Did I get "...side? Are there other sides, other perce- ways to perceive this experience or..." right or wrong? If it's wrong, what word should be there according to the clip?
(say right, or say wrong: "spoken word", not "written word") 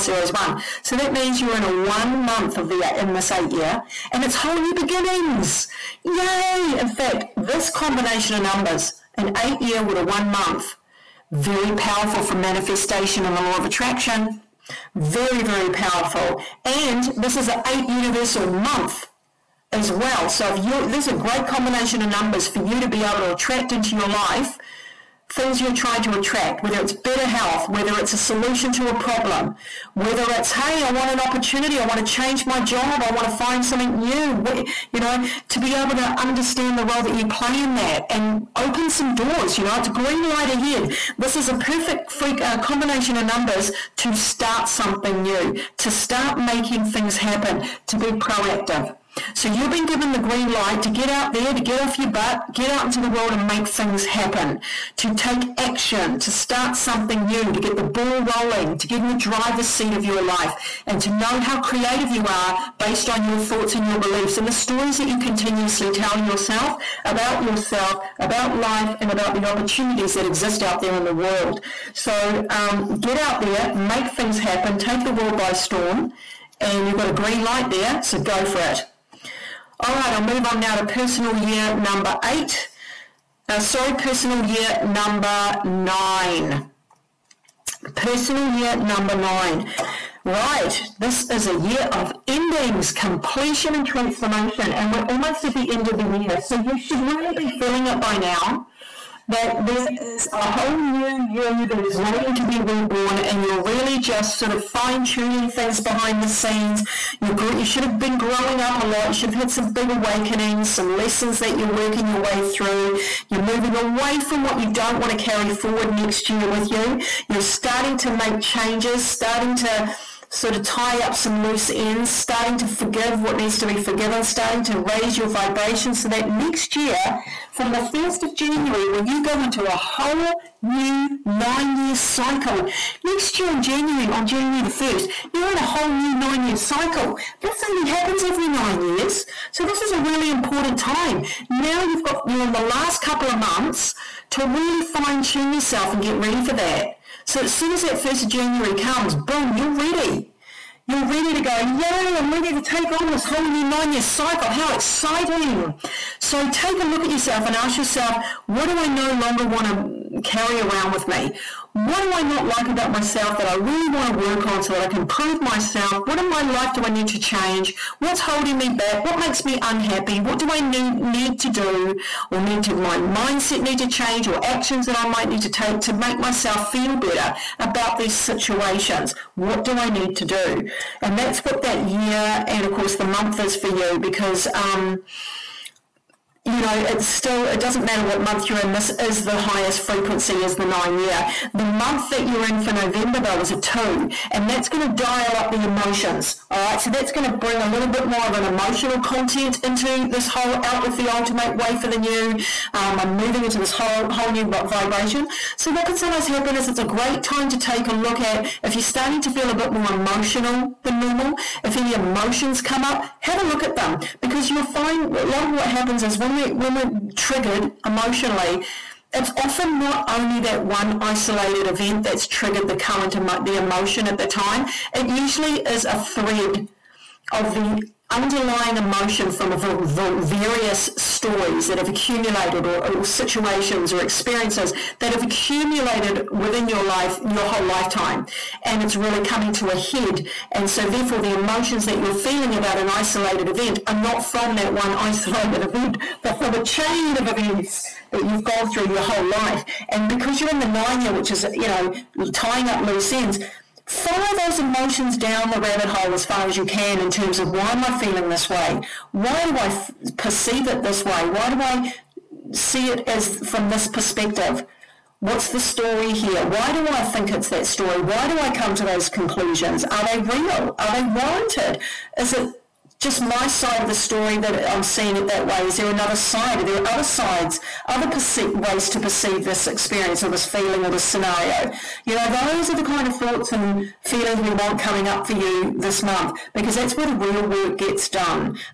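right.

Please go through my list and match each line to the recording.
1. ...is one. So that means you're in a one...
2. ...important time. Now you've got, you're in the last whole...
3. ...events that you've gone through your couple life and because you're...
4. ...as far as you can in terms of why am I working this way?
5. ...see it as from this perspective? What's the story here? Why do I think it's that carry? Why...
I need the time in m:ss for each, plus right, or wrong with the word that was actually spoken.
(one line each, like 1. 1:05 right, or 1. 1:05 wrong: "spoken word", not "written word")
1. 0:00 right
2. 2:20 wrong: "couple", not "whole"
3. 4:07 wrong: "whole", not "couple"
4. 4:16 wrong: "feeling", not "working"
5. 4:22 wrong: "story", not "carry".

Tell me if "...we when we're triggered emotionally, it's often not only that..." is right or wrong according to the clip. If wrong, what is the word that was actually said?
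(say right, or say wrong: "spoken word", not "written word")
right.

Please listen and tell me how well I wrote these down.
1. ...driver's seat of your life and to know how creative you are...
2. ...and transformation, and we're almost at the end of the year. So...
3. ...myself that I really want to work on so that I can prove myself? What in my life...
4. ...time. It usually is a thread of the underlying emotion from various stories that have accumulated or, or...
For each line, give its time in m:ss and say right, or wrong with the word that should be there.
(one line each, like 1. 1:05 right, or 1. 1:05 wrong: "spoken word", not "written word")
1. 0:59 right
2. 1:33 right
3. 2:42 right
4. 3:44 right.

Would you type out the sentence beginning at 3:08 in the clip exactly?
This is the highest frequency is the nine year.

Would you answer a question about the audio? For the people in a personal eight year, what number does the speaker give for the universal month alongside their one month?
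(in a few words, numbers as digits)
8.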